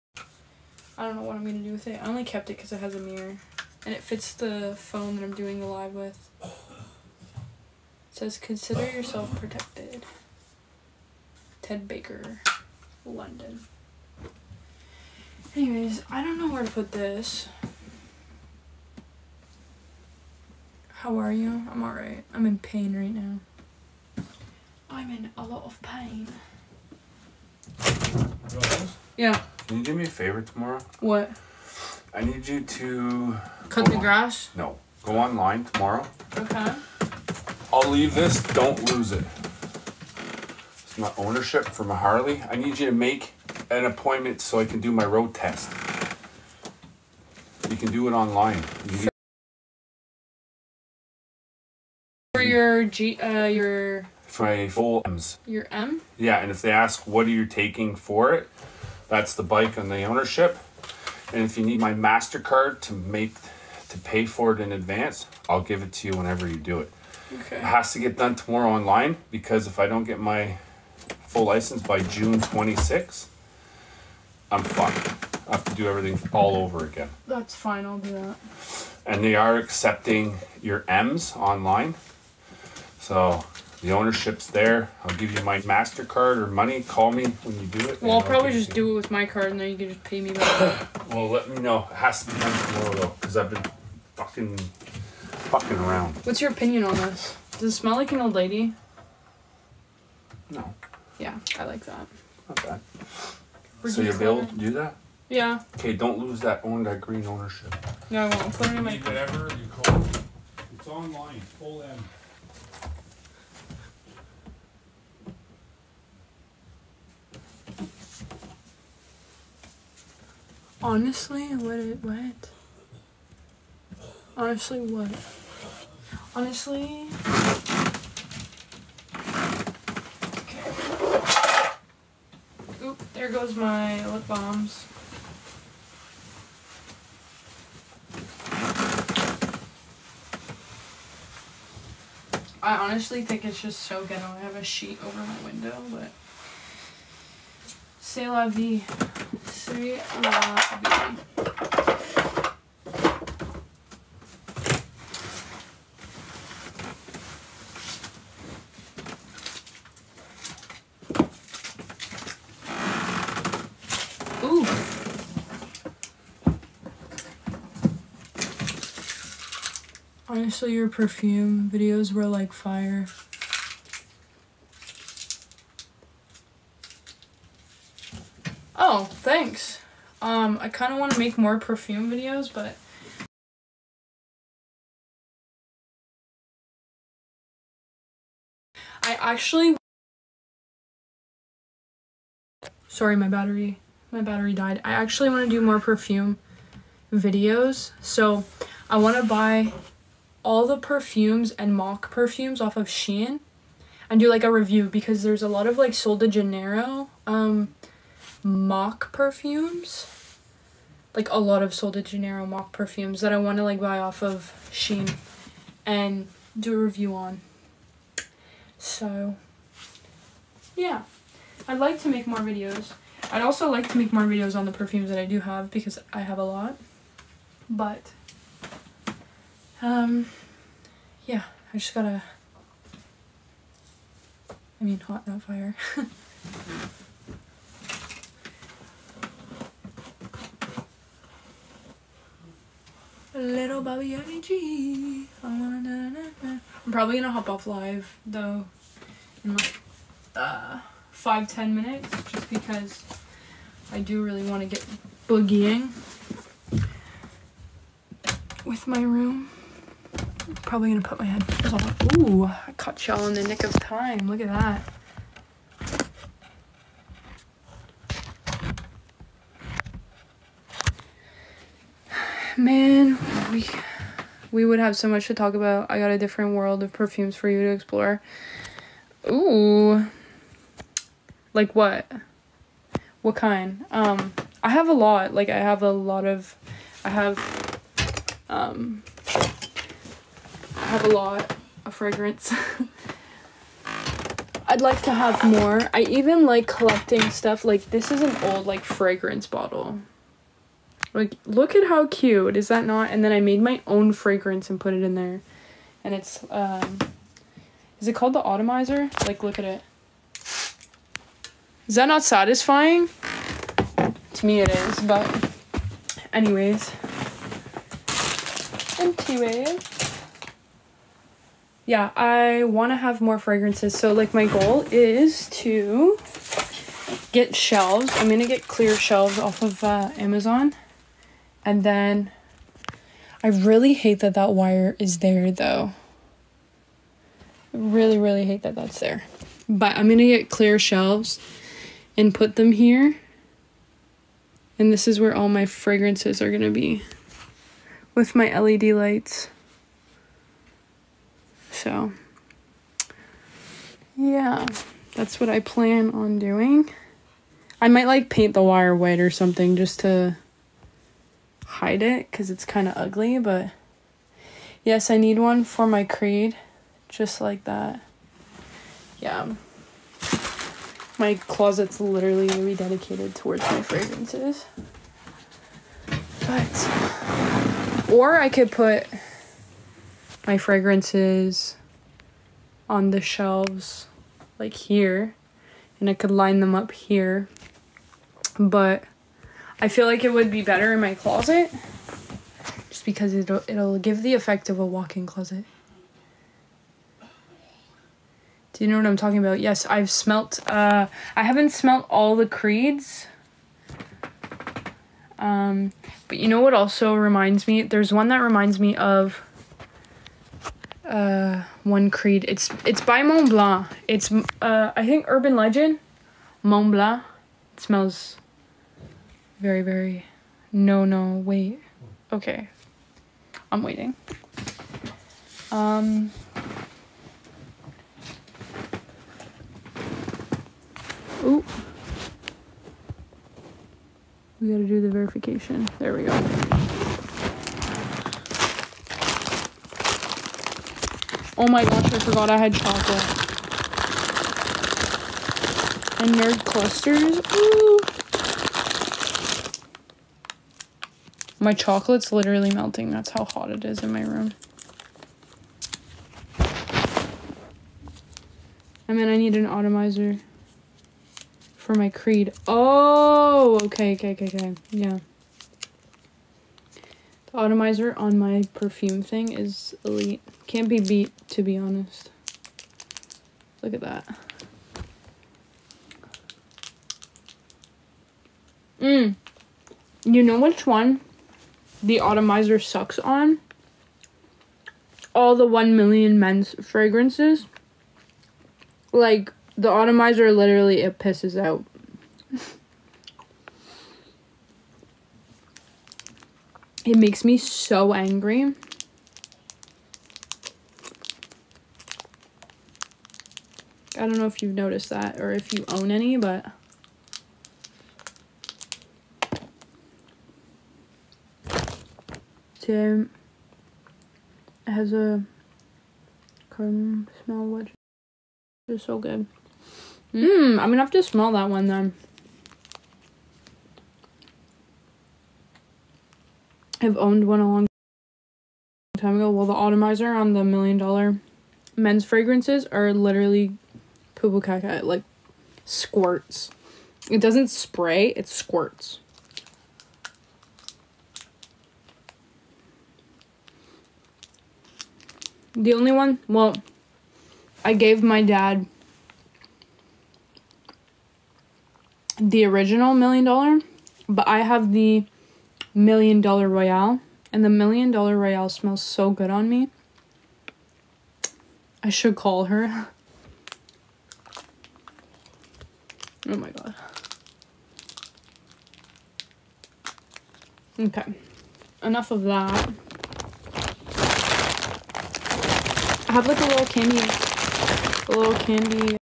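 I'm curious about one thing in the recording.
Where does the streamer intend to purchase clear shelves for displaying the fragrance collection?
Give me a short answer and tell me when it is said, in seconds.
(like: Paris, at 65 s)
Amazon, at 330 s.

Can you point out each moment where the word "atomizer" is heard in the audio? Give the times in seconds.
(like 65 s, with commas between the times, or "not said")
459 s, 467 s, 482 s, 489 s, 529 s.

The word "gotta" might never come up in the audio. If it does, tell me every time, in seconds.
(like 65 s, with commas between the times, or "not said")
231 s, 434 s.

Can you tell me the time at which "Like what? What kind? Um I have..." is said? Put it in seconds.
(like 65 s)
281 s.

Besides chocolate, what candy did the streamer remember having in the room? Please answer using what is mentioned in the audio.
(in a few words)
Nerd clusters.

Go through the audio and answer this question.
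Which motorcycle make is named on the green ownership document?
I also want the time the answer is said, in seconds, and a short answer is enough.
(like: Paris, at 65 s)
Harley, at 41 s.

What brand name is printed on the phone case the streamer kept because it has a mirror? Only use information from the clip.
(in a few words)
Ted Baker.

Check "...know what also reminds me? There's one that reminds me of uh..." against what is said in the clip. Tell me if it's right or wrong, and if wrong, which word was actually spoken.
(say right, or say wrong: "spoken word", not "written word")
right.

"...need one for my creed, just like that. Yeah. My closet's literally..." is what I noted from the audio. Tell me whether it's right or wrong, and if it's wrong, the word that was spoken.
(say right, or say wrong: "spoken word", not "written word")
right.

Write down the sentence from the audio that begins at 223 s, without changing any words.
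I'd also like to make more videos on the perfumes that I do have because I have a lot.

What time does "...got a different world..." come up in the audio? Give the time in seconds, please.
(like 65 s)
275 s.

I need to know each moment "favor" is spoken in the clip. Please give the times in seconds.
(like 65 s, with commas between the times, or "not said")
30 s.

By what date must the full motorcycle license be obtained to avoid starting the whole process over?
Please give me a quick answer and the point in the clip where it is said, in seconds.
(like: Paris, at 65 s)
June 26, at 72 s.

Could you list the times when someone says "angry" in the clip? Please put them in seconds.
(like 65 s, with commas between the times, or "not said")
498 s.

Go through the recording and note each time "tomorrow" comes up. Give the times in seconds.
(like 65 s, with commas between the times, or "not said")
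30 s, 35 s, 68 s, 92 s.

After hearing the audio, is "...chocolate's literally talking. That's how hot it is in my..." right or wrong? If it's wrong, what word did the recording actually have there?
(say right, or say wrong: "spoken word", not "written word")
wrong: "melting", not "talking".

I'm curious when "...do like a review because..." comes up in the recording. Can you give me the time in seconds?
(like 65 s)
204 s.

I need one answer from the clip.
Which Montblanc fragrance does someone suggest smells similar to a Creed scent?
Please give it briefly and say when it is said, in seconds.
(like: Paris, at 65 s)
Urban Legend, at 415 s.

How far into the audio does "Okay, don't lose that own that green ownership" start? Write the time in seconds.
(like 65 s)
105 s.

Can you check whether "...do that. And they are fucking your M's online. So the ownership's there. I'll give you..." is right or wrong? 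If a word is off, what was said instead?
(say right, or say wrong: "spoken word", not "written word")
wrong: "accepting", not "fucking".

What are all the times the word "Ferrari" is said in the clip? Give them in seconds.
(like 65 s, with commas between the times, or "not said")
not said.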